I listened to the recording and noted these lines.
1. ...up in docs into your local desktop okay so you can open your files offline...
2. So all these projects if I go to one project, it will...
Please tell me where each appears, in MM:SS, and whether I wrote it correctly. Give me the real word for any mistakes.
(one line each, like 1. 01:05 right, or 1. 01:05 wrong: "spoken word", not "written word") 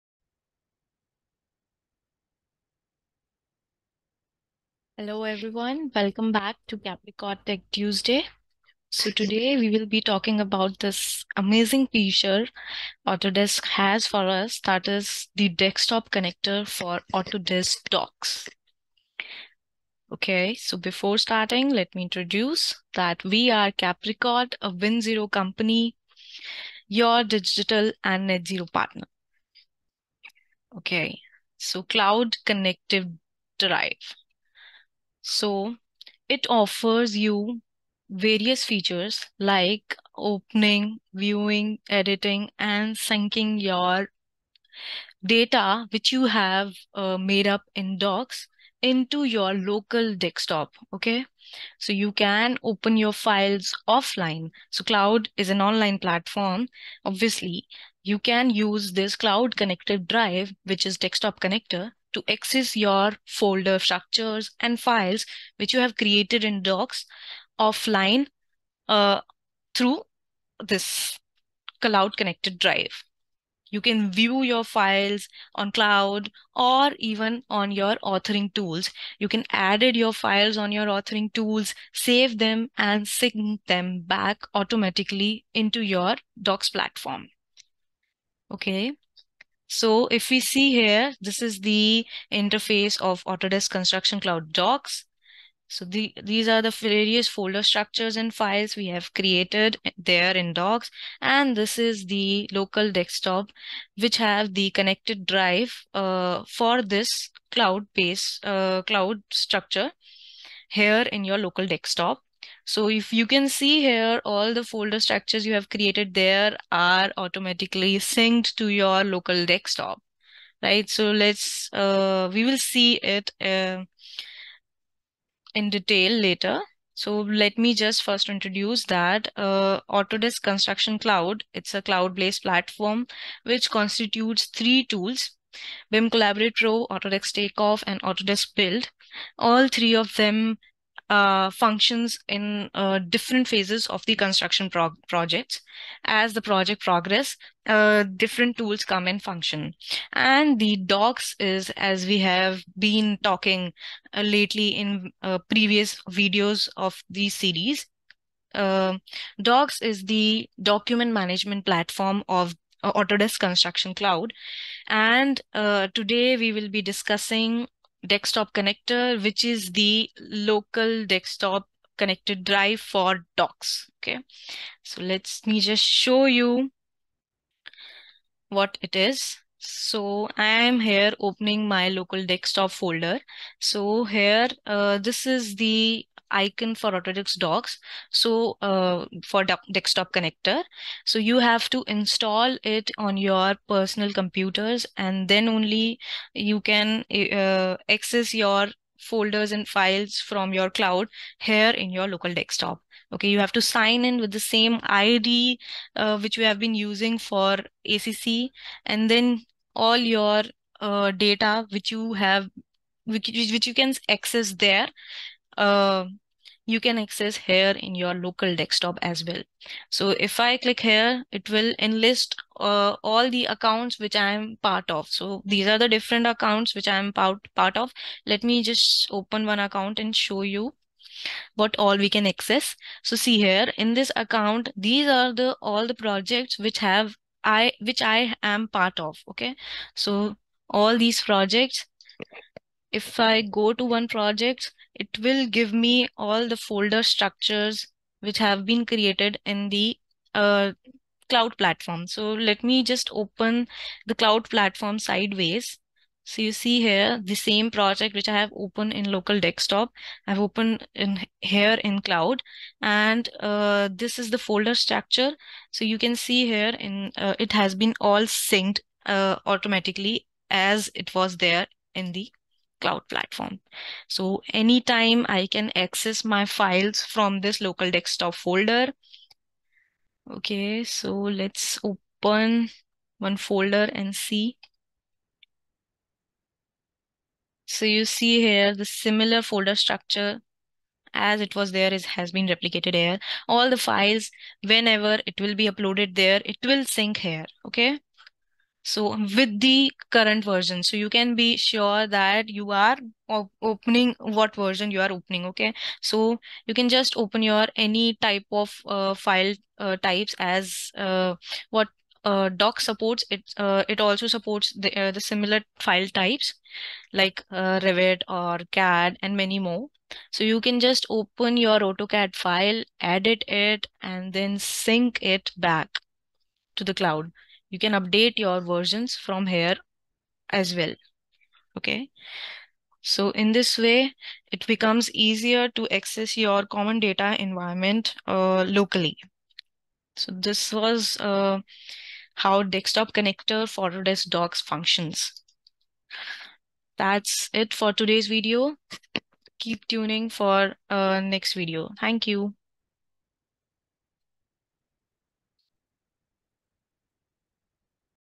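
1. 00:47 right
2. 03:59 right.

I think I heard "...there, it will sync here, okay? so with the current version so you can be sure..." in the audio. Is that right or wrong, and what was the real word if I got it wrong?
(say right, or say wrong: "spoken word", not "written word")
right.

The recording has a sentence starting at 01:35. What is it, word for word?
So the, these are the various folder structures and files we have created there in Docs.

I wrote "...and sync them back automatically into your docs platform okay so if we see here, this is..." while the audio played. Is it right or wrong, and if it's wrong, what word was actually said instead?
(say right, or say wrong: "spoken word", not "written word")
right.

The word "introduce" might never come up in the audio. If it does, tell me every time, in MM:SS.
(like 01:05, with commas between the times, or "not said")
00:22, 02:08.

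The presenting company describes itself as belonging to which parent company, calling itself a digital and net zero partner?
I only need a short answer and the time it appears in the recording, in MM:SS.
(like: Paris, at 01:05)
Win Zero, at 00:24.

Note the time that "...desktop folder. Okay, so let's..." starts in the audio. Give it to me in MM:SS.
04:37.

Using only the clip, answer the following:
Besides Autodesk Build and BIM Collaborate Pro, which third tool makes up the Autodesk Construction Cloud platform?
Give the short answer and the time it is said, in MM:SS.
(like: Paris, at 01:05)
Autodesk Takeoff, at 02:16.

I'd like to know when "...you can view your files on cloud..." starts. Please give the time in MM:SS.
01:13.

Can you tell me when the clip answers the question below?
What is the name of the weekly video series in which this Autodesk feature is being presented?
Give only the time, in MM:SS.
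00:06.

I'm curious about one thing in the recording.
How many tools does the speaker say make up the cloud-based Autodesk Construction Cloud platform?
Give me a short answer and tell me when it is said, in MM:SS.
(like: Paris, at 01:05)
3, at 02:14.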